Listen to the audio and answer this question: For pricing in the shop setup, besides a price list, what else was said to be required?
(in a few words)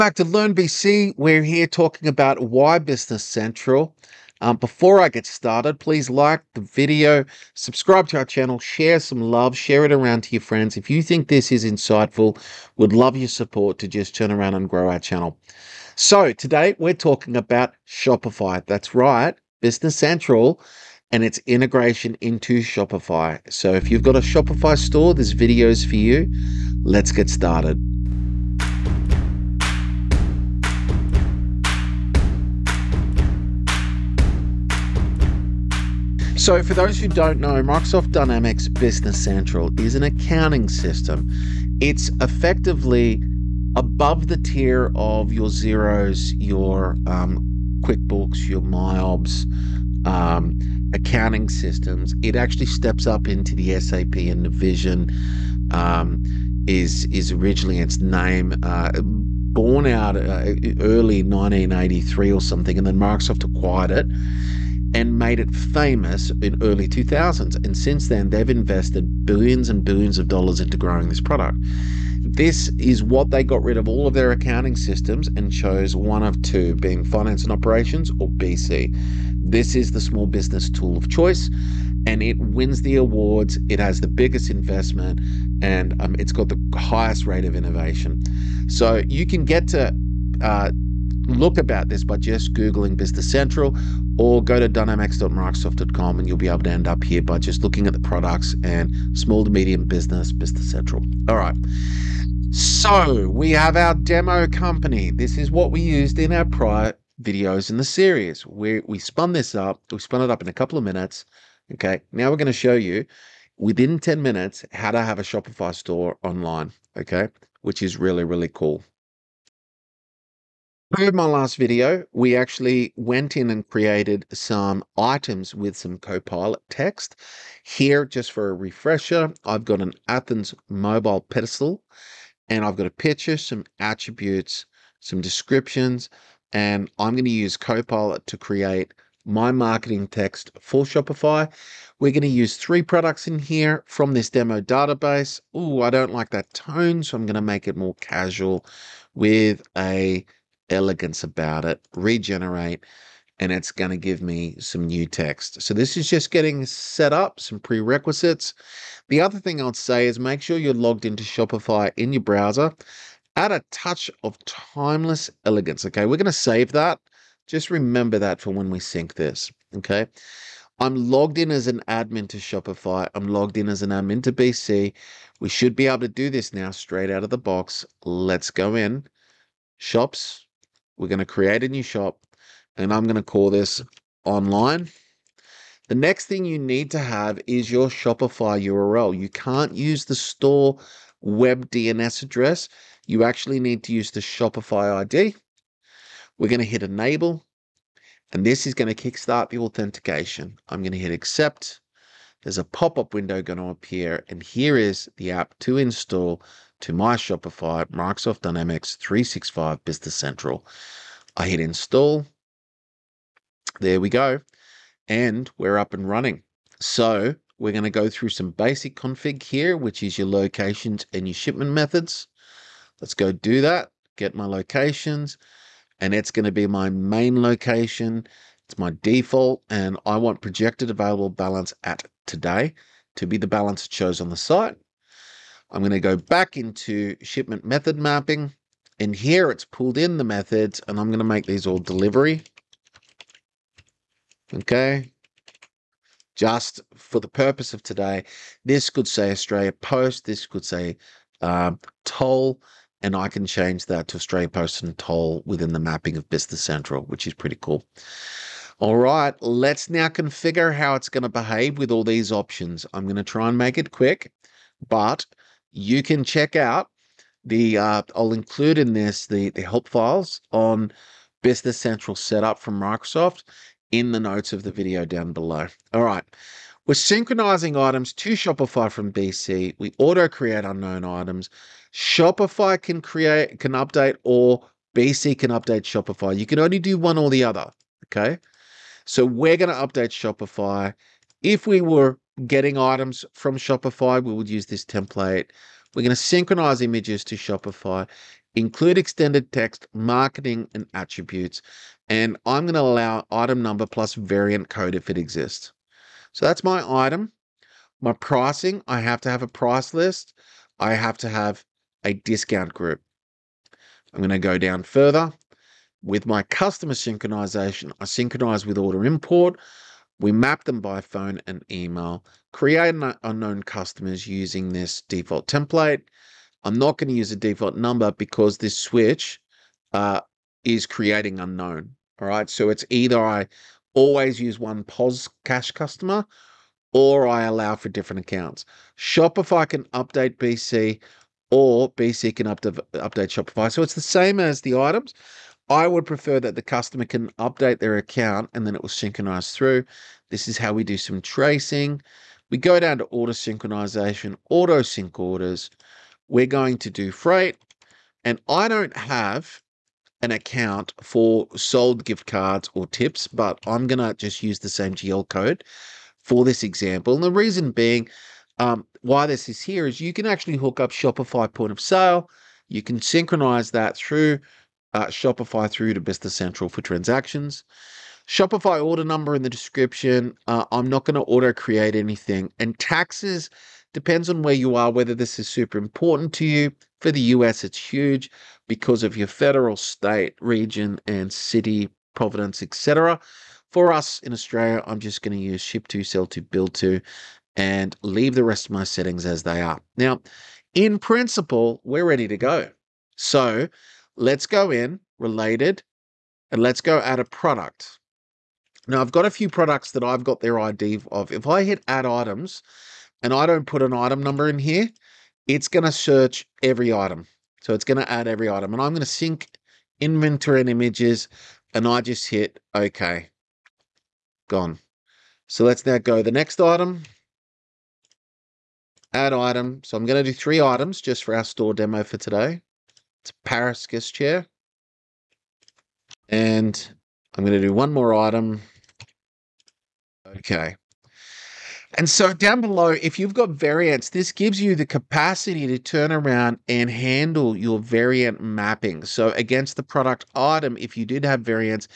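discount group.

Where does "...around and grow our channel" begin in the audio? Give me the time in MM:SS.
00:14.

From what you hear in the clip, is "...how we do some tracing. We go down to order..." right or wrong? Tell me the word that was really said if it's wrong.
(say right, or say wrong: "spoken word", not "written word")
right.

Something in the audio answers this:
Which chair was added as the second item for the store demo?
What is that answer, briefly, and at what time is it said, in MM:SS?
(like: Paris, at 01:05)
Paris Guest chair, at 07:13.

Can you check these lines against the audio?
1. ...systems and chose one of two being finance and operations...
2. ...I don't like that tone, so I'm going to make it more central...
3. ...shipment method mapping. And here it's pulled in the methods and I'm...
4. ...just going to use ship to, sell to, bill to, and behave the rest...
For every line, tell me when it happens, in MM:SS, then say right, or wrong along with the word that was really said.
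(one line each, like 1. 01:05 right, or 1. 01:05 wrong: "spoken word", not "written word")
1. 01:14 right
2. 02:25 wrong: "casual", not "central"
3. 03:57 right
4. 06:34 wrong: "leave", not "behave".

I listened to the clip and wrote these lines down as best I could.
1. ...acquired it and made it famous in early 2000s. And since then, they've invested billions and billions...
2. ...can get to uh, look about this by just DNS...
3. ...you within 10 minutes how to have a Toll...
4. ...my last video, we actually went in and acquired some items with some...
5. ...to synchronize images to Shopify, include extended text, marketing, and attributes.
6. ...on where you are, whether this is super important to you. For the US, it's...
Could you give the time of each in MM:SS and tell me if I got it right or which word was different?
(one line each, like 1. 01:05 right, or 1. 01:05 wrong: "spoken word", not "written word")
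1. 01:03 right
2. 01:29 wrong: "Googling", not "DNS"
3. 01:52 wrong: "Shopify", not "Toll"
4. 02:01 wrong: "created", not "acquired"
5. 04:56 right
6. 06:24 right.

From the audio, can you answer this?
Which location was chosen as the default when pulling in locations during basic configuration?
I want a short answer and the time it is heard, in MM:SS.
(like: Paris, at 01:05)
main location, at 03:46.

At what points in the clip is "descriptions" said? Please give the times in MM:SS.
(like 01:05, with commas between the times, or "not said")
02:15, 06:19.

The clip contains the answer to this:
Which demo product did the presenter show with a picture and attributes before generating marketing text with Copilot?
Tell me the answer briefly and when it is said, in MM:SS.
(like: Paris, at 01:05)
Athens mobile pedestal, at 02:10.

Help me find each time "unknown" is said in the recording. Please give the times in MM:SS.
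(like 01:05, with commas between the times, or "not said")
04:40, 05:23, 05:31.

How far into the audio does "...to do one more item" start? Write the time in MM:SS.
07:17.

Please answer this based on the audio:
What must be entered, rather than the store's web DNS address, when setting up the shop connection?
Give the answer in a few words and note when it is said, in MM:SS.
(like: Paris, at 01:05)
Shopify ID, at 03:14.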